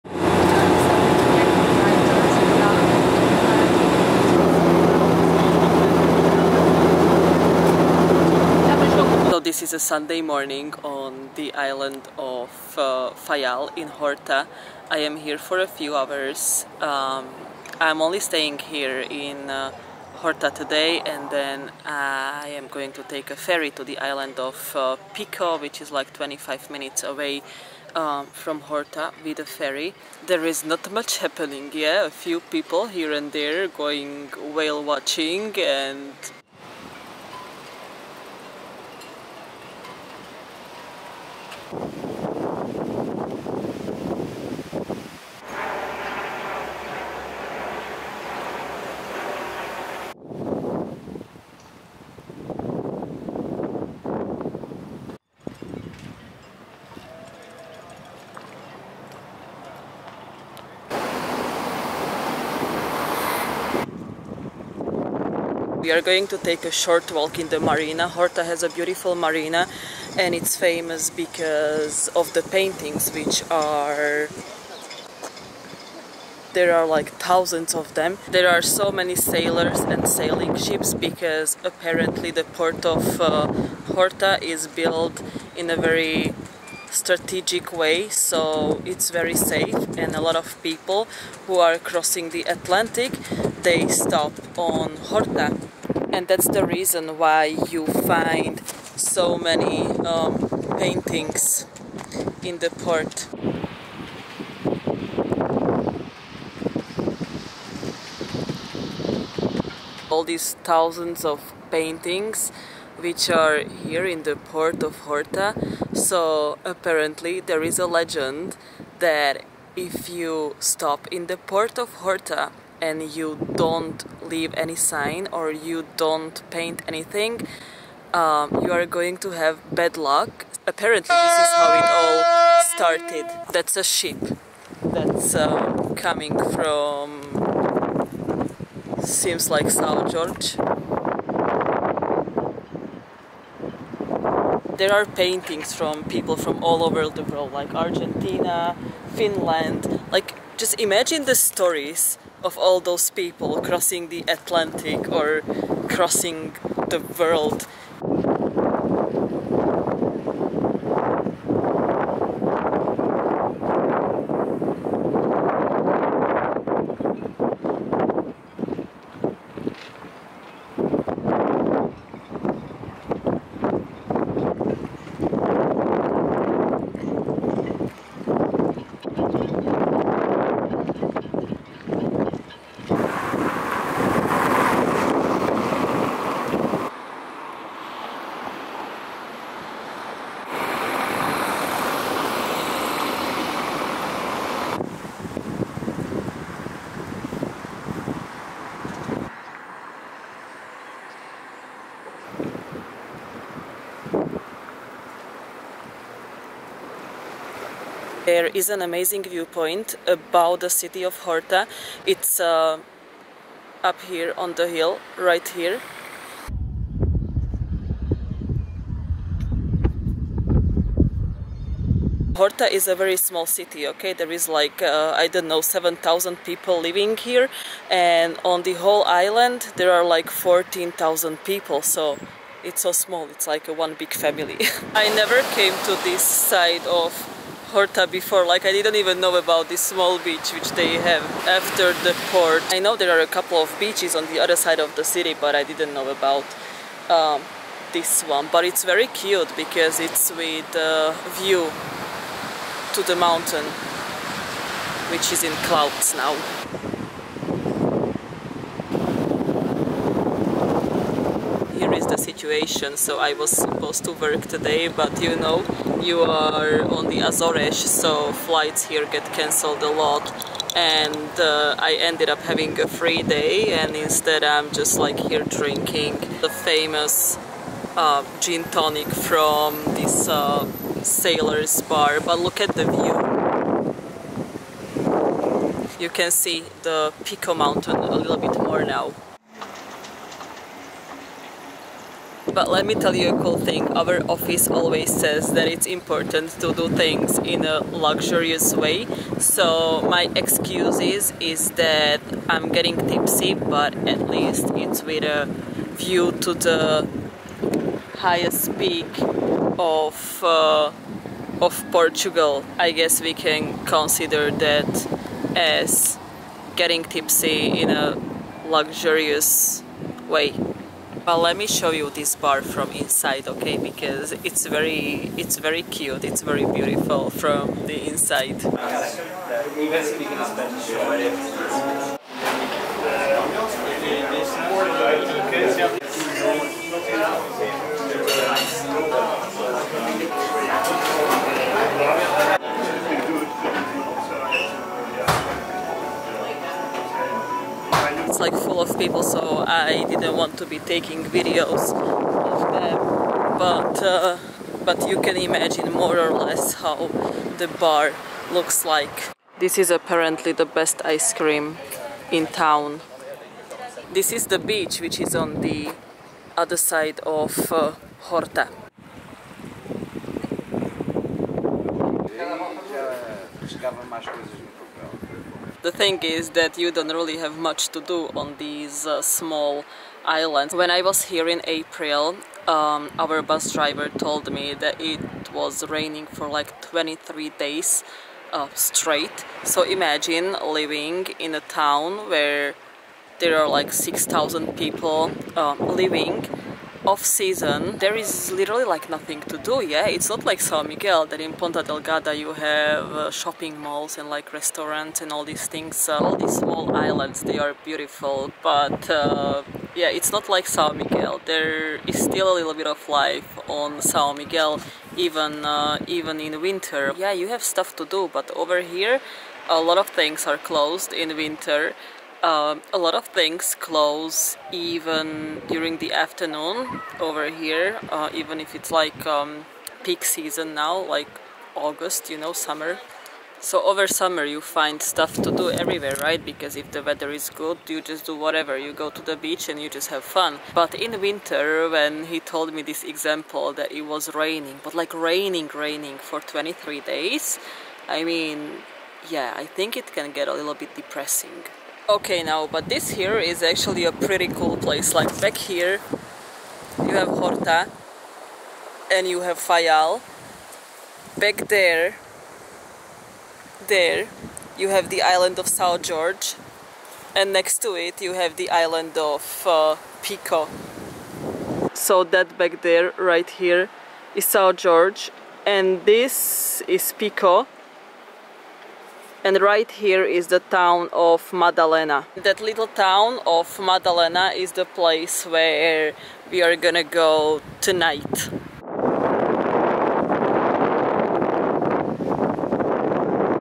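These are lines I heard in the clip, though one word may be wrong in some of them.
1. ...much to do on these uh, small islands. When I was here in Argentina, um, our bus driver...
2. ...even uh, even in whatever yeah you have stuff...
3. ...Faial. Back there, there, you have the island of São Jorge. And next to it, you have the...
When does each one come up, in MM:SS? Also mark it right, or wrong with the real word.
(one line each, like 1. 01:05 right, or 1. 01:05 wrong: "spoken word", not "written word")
1. 06:17 wrong: "April", not "Argentina"
2. 06:55 wrong: "winter", not "whatever"
3. 07:39 right.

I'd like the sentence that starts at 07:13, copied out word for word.
So over summer you find stuff to do everywhere, right?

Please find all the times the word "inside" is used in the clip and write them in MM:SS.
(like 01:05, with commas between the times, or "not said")
05:22, 05:28.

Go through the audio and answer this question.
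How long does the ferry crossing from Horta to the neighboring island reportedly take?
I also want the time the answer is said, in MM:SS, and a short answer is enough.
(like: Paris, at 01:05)
25 minutes, at 00:26.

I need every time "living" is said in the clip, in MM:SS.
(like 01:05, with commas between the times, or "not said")
03:46, 06:30, 06:35.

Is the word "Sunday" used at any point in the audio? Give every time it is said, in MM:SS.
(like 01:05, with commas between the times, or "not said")
00:09.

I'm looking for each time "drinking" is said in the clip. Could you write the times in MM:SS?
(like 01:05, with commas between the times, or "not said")
04:35.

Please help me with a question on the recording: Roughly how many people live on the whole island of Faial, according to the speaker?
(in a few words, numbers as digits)
14,000.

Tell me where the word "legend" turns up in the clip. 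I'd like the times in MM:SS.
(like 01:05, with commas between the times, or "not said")
01:57.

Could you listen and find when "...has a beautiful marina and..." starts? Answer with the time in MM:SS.
01:08.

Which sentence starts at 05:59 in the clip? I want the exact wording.
This is apparently the best ice cream in town.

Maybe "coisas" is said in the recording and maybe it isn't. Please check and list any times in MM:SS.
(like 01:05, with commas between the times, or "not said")
06:14.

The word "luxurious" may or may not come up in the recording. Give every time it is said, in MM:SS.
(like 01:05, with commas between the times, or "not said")
04:57, 05:18.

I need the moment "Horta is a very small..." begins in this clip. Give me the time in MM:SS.
03:42.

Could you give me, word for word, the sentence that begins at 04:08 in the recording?
But it's very cute because it's with uh, view to the mountain, which is in clouds now.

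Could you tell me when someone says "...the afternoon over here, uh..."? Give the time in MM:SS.
07:05.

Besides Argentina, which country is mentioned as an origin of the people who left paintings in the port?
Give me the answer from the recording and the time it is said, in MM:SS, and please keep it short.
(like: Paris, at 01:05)
Finland, at 02:29.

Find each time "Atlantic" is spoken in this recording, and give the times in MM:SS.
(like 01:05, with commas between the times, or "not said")
01:32, 02:34.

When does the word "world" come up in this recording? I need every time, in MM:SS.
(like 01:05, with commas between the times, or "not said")
02:27, 02:37.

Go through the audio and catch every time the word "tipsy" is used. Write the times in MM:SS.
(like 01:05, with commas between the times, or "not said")
05:03, 05:17.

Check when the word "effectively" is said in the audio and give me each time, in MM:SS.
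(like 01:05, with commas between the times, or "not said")
not said.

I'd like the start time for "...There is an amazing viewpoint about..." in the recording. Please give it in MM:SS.
03:28.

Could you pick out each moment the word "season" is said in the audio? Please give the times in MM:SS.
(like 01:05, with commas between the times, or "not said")
06:37, 07:10.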